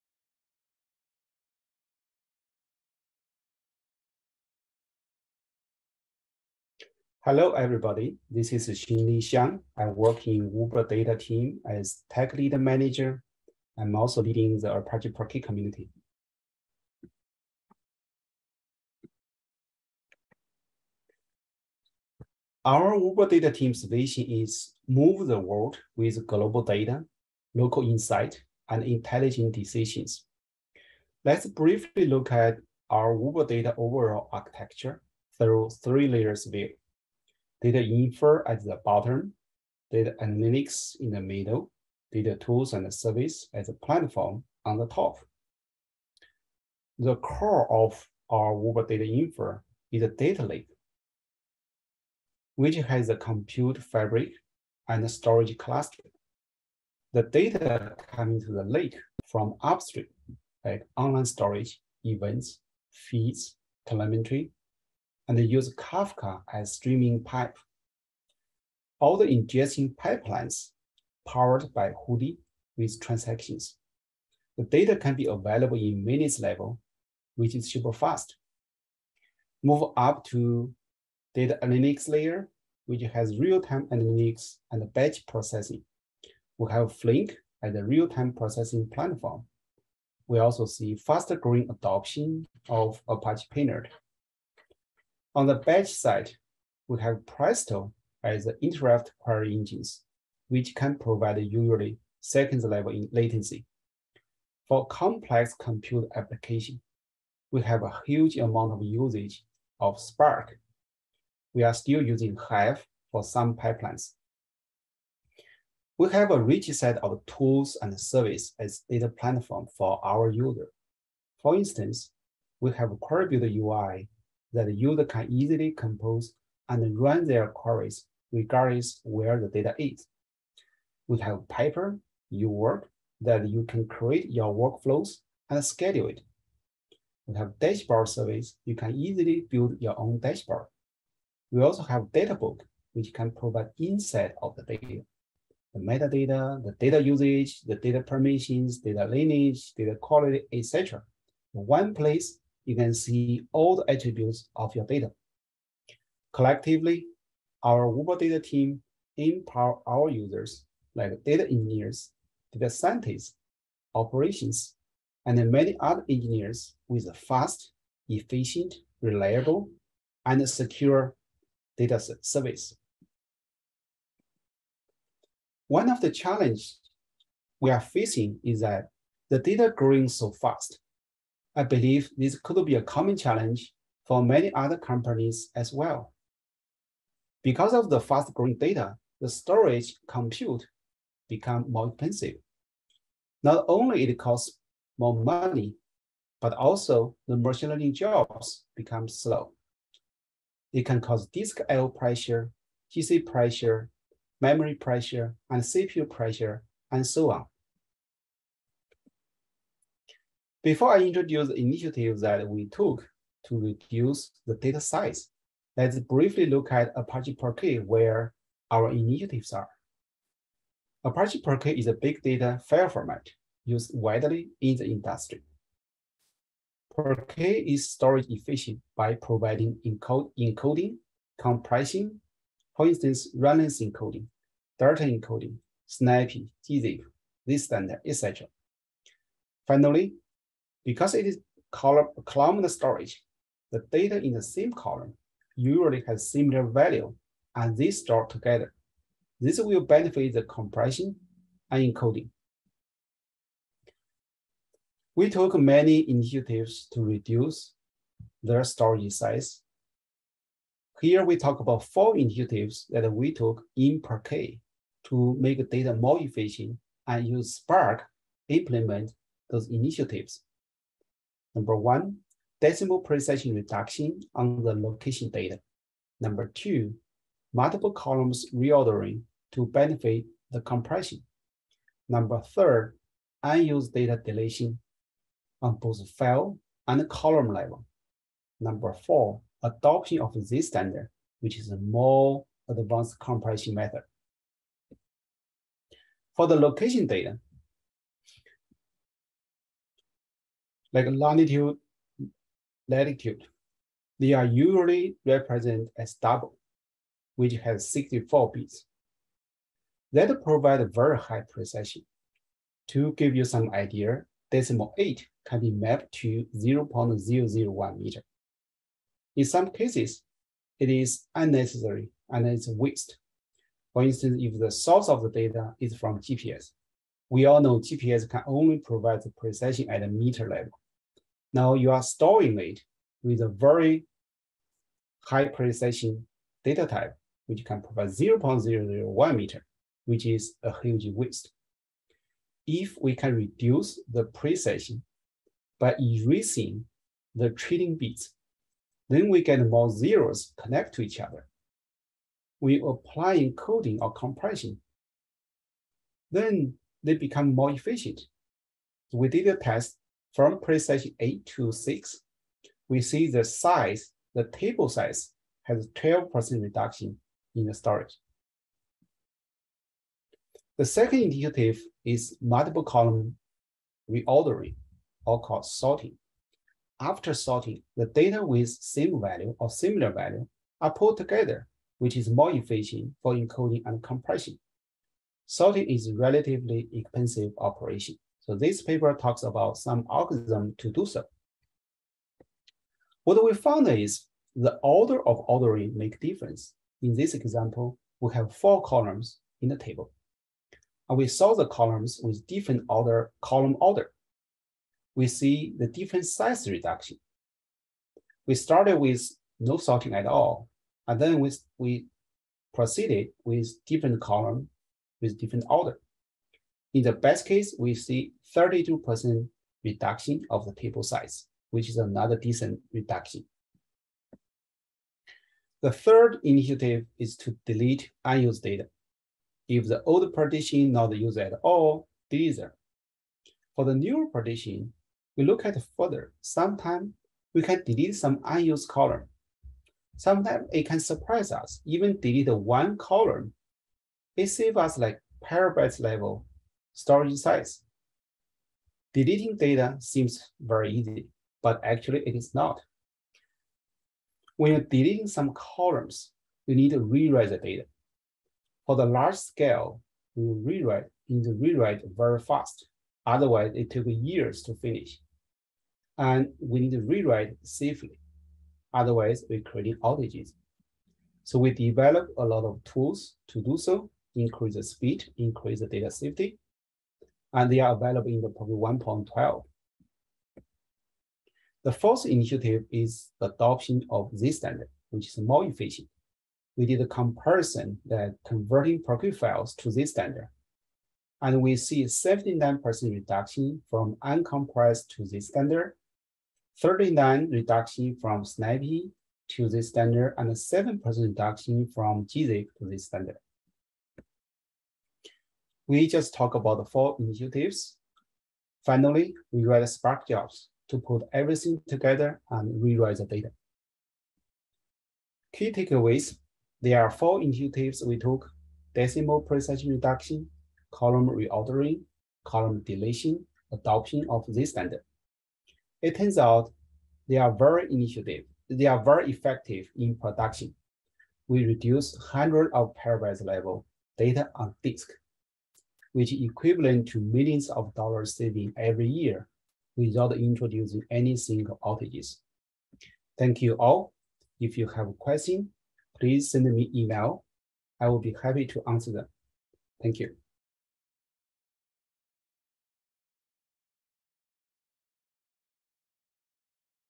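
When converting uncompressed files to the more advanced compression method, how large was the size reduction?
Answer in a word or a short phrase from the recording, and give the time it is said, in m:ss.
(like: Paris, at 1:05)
79%, at 8:12.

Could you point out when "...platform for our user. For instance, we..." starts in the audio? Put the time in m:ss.
1:59.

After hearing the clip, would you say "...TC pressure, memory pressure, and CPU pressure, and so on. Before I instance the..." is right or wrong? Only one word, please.
wrong.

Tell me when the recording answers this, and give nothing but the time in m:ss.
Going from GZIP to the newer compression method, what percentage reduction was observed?
8:20.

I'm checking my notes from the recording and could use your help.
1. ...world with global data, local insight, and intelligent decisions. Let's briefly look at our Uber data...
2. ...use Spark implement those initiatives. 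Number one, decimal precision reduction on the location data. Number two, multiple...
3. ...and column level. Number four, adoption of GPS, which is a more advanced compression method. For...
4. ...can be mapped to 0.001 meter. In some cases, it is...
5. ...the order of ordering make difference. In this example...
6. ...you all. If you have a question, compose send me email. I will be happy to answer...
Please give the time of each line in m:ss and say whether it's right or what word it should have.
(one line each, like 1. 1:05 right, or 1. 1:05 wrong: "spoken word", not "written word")
1. 0:25 right
2. 4:27 right
3. 4:46 wrong: "Zstandard", not "GPS"
4. 5:15 right
5. 6:34 right
6. 9:03 wrong: "please", not "compose".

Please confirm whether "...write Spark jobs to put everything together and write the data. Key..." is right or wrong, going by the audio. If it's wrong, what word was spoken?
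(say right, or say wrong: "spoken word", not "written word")
wrong: "rewrite", not "write".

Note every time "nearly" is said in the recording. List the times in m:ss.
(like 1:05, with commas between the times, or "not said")
not said.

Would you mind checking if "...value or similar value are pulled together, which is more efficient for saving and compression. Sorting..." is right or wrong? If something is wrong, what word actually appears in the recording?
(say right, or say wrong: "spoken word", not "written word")
wrong: "encoding", not "saving".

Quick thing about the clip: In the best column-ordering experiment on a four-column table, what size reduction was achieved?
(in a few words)
32%.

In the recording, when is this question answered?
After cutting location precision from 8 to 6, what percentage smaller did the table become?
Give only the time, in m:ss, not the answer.
6:05.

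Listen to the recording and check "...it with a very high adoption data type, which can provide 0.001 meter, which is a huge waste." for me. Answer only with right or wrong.
wrong.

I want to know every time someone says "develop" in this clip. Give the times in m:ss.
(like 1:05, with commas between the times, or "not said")
7:51.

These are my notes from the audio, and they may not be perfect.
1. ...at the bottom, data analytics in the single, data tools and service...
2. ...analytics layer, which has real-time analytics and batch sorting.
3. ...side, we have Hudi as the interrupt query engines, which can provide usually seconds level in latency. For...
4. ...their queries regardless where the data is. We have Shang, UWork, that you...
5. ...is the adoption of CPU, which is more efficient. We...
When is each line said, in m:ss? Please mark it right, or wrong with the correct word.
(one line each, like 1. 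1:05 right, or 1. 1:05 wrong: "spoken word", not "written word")
1. 0:38 wrong: "middle", not "single"
2. 1:21 wrong: "processing", not "sorting"
3. 1:35 wrong: "Presto", not "Hudi"
4. 2:07 wrong: "Piper", not "Shang"
5. 8:02 wrong: "Zstandard", not "CPU".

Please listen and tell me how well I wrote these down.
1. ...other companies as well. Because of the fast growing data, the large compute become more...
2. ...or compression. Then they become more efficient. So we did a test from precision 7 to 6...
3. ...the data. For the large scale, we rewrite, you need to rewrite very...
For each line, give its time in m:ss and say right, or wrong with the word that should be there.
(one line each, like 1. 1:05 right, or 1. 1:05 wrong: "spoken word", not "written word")
1. 3:04 wrong: "storage", not "large"
2. 5:54 wrong: "8", not "7"
3. 7:37 right.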